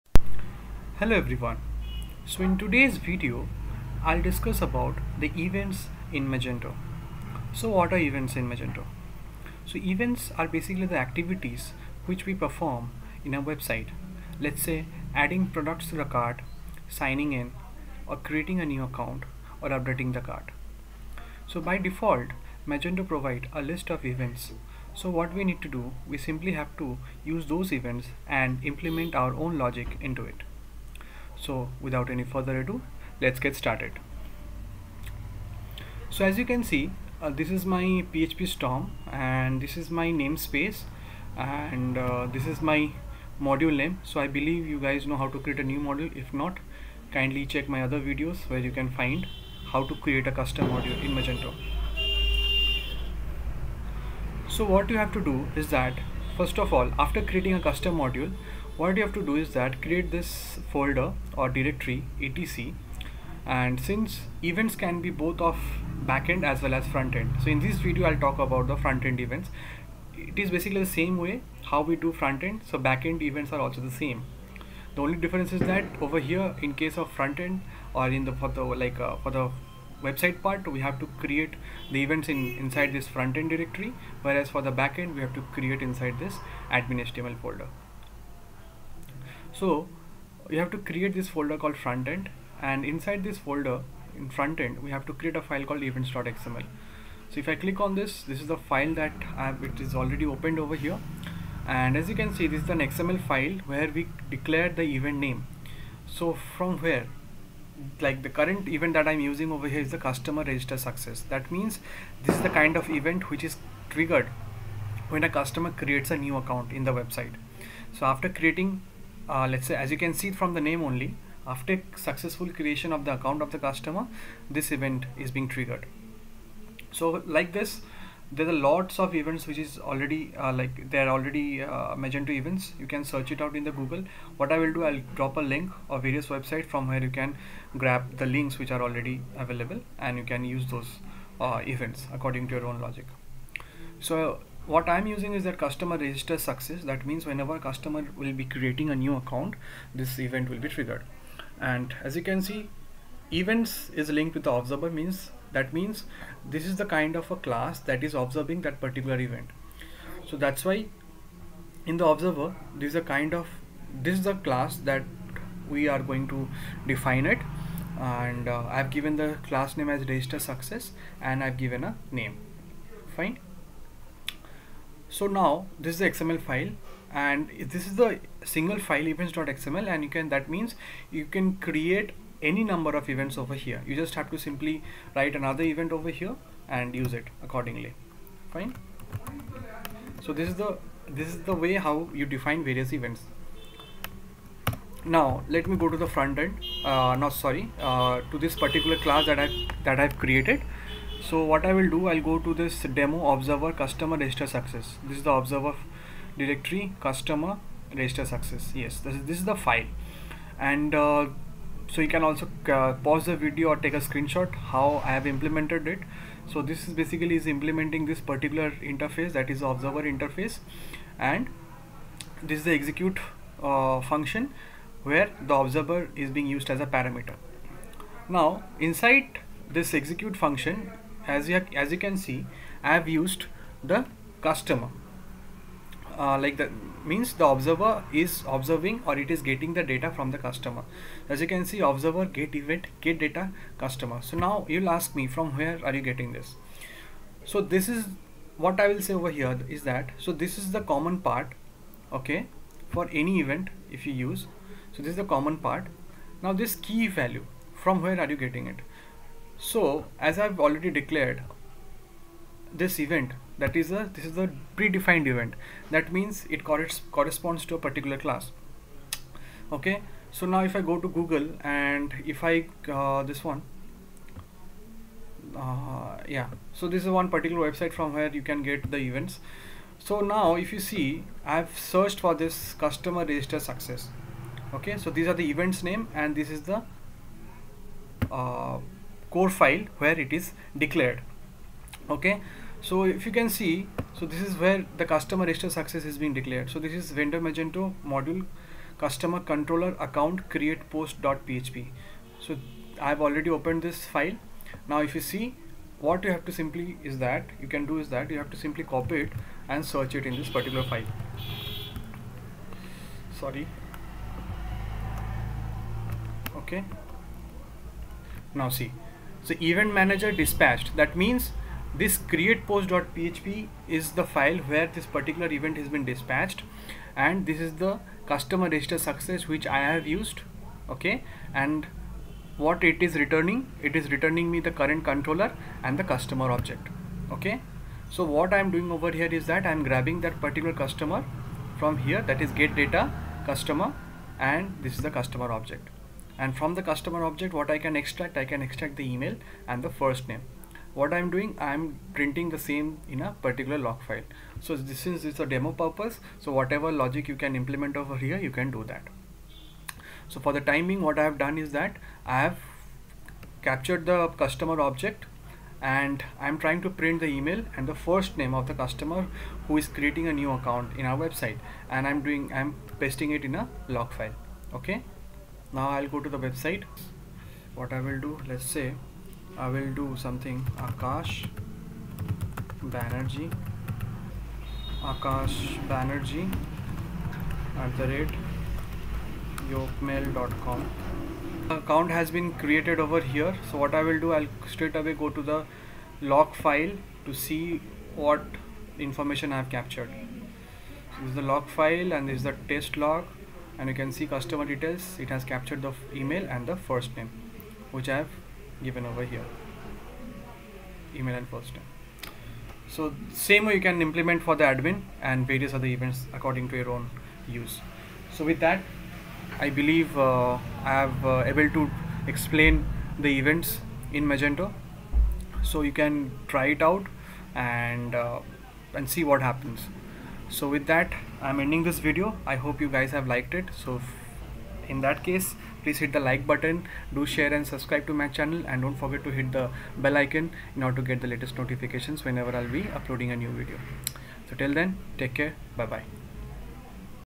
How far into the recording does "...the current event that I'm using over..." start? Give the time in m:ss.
1:48.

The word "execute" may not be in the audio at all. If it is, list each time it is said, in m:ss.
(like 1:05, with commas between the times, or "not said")
3:42, 3:49.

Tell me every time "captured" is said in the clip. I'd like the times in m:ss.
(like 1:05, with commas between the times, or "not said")
6:03, 6:39, 6:45.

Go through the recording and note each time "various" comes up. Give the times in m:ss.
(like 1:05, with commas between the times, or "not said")
2:16, 3:12, 6:55.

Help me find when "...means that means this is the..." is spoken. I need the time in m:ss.
2:34.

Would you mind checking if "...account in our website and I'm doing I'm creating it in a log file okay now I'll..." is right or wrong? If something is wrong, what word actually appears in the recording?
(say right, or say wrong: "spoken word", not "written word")
wrong: "pasting", not "creating".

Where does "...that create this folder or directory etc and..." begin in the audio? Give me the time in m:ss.
0:59.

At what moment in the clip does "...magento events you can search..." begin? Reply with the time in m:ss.
2:12.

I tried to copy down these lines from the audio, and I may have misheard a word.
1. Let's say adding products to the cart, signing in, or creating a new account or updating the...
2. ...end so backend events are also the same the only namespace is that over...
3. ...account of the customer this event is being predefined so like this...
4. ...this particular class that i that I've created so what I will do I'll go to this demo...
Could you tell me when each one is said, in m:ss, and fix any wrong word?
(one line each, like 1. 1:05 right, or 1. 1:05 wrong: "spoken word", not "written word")
1. 0:14 right
2. 1:12 wrong: "difference", not "namespace"
3. 2:03 wrong: "triggered", not "predefined"
4. 3:18 right.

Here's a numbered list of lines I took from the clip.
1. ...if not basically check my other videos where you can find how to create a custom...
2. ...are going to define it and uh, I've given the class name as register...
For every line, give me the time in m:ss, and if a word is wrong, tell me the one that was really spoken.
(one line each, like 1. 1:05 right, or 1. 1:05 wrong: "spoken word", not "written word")
1. 0:46 wrong: "kindly", not "basically"
2. 2:45 right.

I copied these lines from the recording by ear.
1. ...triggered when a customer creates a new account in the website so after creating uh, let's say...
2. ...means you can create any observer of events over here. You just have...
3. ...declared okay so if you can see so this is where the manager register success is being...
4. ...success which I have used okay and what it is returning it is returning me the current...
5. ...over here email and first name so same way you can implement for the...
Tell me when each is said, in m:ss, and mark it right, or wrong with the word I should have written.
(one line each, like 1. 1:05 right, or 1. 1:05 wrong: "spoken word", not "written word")
1. 1:53 right
2. 3:00 wrong: "number", not "observer"
3. 4:50 wrong: "customer", not "manager"
4. 5:28 right
5. 6:49 right.